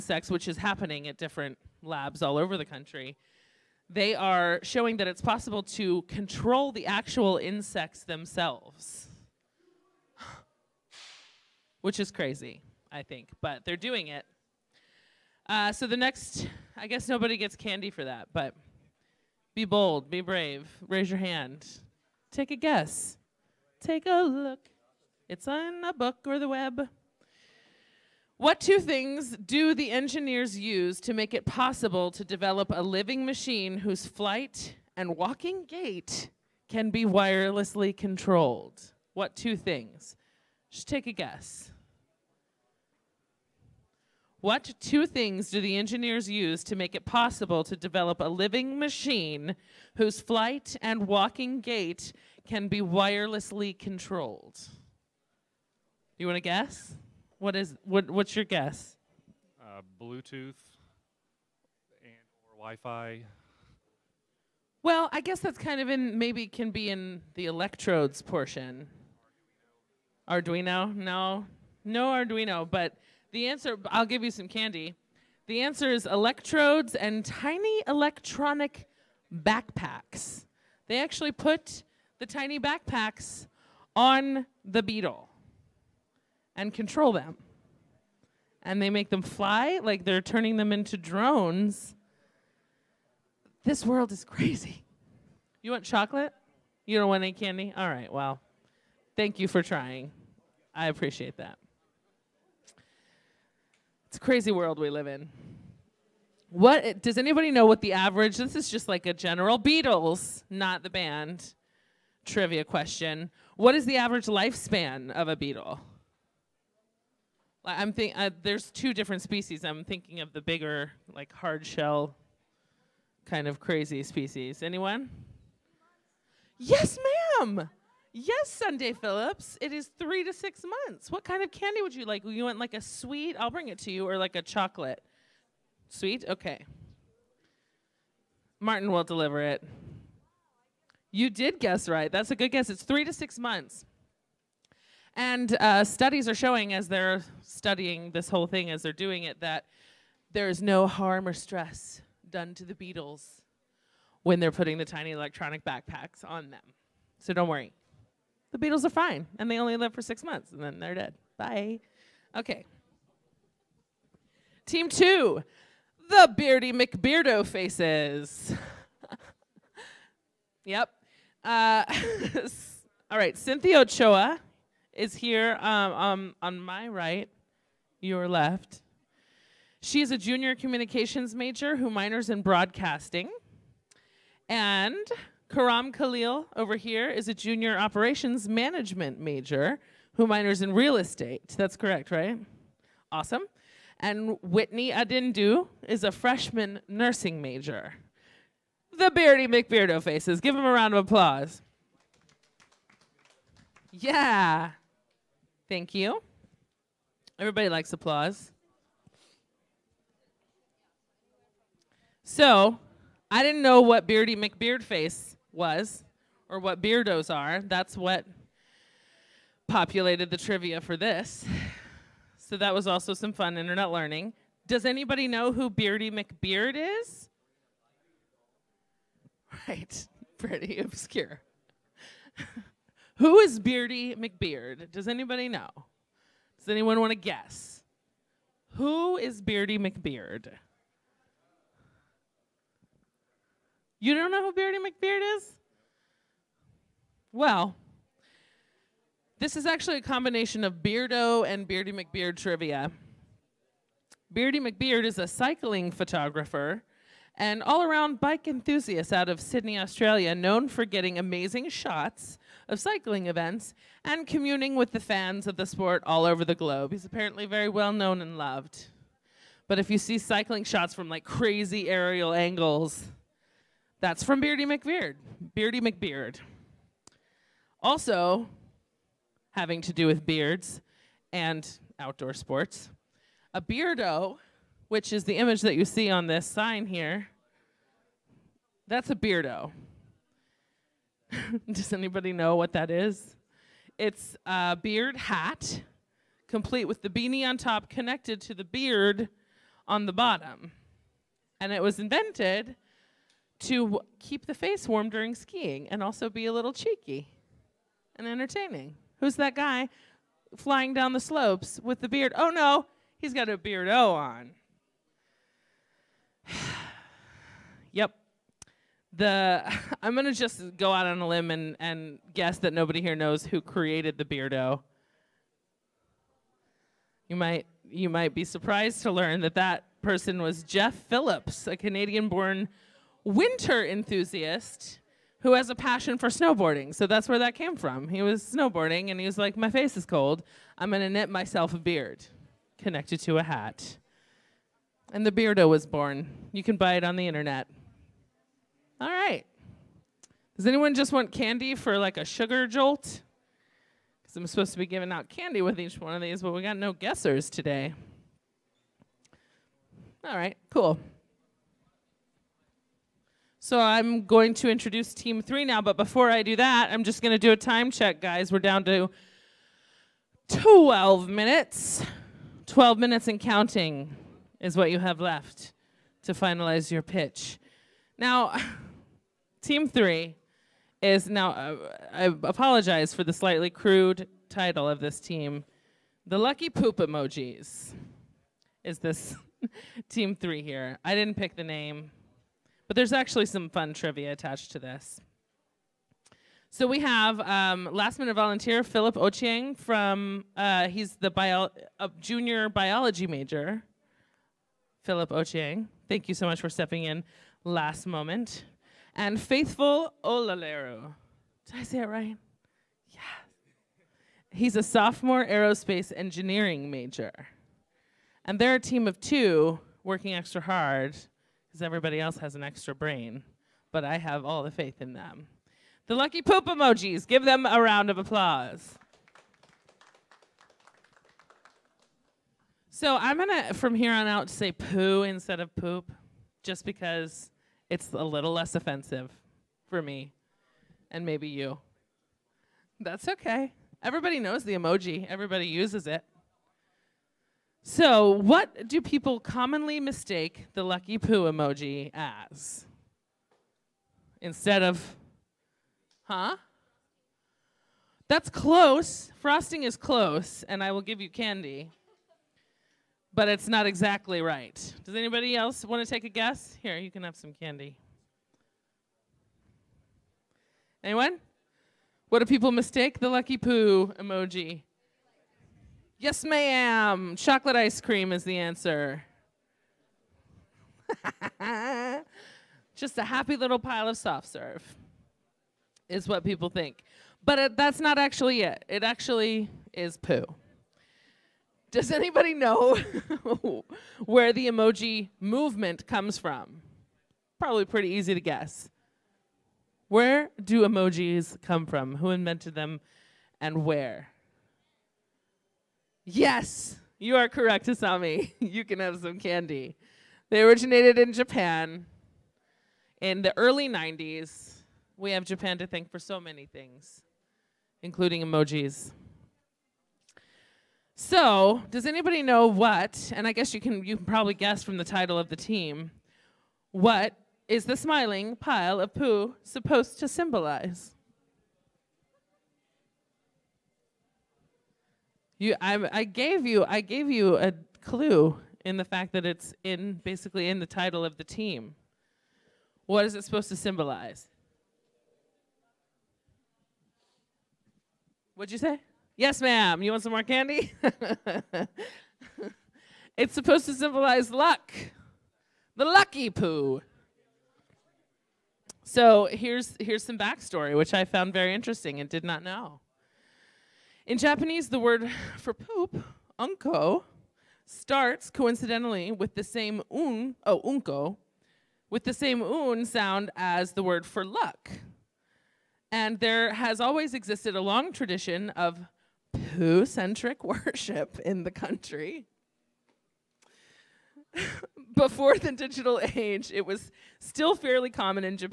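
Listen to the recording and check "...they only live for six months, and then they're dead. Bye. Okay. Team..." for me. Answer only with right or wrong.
right.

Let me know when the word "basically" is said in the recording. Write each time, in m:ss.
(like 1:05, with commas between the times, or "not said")
9:00.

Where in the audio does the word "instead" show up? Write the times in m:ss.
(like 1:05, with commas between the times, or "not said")
7:15, 7:34.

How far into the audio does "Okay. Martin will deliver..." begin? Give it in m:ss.
2:16.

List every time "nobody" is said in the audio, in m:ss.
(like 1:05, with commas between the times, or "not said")
0:17, 5:22.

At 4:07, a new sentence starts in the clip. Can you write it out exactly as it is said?
Well, this is actually a combination of Beardo and Beardy McBeard trivia.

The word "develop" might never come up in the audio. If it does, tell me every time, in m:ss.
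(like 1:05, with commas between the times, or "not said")
0:32, 0:47.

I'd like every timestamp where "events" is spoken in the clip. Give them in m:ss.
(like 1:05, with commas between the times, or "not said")
4:23.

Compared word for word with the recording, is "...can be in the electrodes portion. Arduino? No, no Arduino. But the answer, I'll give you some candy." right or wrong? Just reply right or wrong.
right.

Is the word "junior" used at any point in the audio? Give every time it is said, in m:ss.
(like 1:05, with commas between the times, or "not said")
3:00, 3:07, 6:42.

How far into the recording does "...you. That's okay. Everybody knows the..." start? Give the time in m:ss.
7:21.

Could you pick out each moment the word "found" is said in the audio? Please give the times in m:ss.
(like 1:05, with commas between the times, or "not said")
9:21.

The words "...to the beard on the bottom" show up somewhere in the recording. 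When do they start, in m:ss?
4:58.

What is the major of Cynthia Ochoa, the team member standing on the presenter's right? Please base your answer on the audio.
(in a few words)
Communications.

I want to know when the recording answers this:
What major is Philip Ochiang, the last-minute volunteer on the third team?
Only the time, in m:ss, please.
6:42.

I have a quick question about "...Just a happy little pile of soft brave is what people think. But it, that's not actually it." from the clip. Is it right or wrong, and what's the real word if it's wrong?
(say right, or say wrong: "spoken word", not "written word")
wrong: "serve", not "brave".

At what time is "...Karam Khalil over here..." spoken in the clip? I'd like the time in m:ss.
3:05.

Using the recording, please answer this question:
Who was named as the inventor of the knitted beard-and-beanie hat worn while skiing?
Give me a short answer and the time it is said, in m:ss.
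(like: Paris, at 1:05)
Jeff Phillips, at 5:30.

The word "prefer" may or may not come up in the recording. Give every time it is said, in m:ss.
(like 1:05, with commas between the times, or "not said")
not said.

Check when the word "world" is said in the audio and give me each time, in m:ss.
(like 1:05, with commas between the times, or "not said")
1:33, 1:44.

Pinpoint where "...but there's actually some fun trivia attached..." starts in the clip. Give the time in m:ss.
6:32.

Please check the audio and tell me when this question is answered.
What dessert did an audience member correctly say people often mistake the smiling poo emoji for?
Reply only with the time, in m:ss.
7:57.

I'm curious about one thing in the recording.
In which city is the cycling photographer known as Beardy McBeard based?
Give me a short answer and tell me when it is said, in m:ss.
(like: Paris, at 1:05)
Sydney, Australia, at 4:19.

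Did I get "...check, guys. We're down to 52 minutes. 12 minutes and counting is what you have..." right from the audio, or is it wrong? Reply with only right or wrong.
wrong.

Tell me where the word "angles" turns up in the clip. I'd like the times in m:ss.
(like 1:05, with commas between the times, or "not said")
4:32.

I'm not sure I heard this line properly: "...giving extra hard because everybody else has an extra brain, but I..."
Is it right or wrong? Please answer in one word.
wrong.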